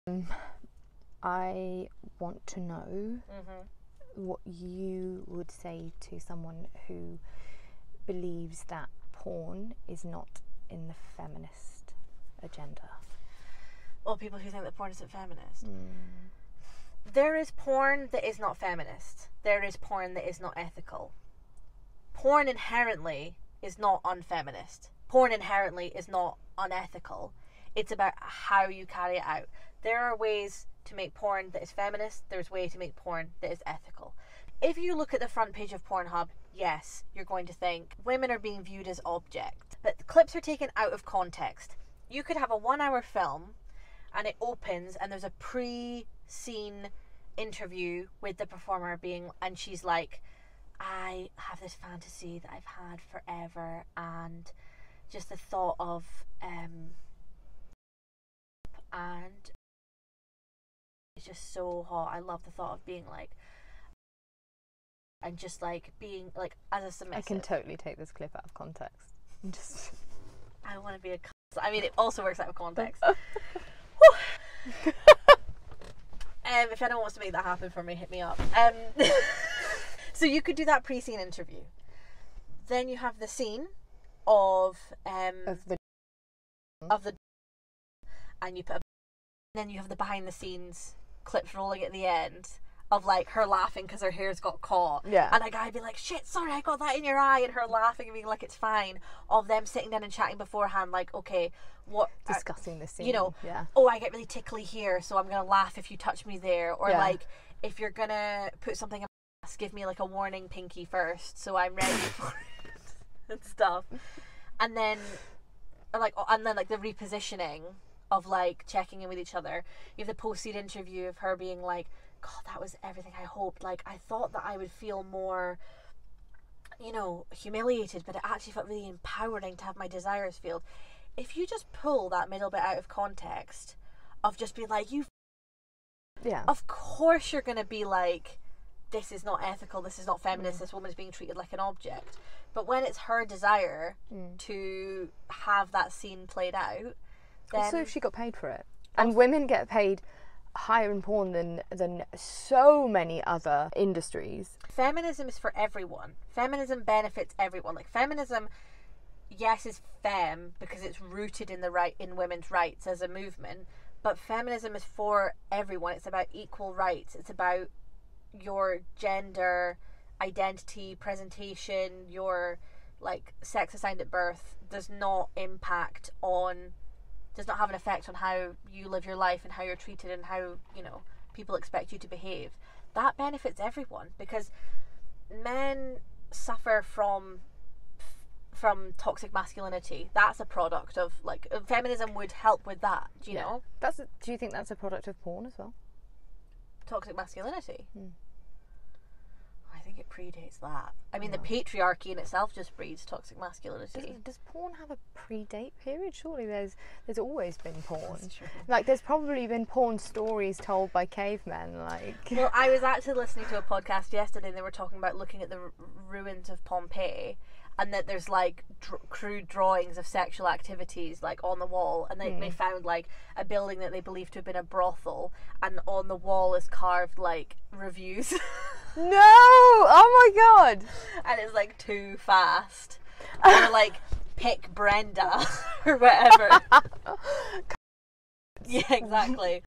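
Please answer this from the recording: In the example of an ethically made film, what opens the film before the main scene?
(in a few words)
Pre-scene interview.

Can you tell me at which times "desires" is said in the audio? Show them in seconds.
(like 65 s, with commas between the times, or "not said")
129 s, 143 s.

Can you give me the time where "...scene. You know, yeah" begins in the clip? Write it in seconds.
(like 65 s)
102 s.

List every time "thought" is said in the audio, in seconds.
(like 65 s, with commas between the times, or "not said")
55 s, 62 s, 124 s.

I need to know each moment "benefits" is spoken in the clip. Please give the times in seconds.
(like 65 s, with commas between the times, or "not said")
156 s, 183 s.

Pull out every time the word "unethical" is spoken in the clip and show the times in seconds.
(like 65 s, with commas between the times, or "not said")
26 s.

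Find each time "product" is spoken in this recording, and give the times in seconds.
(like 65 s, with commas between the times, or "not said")
190 s, 194 s.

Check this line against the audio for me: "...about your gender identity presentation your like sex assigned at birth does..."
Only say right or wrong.
right.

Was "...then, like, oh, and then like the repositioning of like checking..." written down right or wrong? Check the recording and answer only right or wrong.
right.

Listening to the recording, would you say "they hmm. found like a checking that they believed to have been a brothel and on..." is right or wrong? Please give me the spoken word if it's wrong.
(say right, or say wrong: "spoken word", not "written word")
wrong: "building", not "checking".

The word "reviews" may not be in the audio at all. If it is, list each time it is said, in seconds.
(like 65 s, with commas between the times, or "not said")
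227 s.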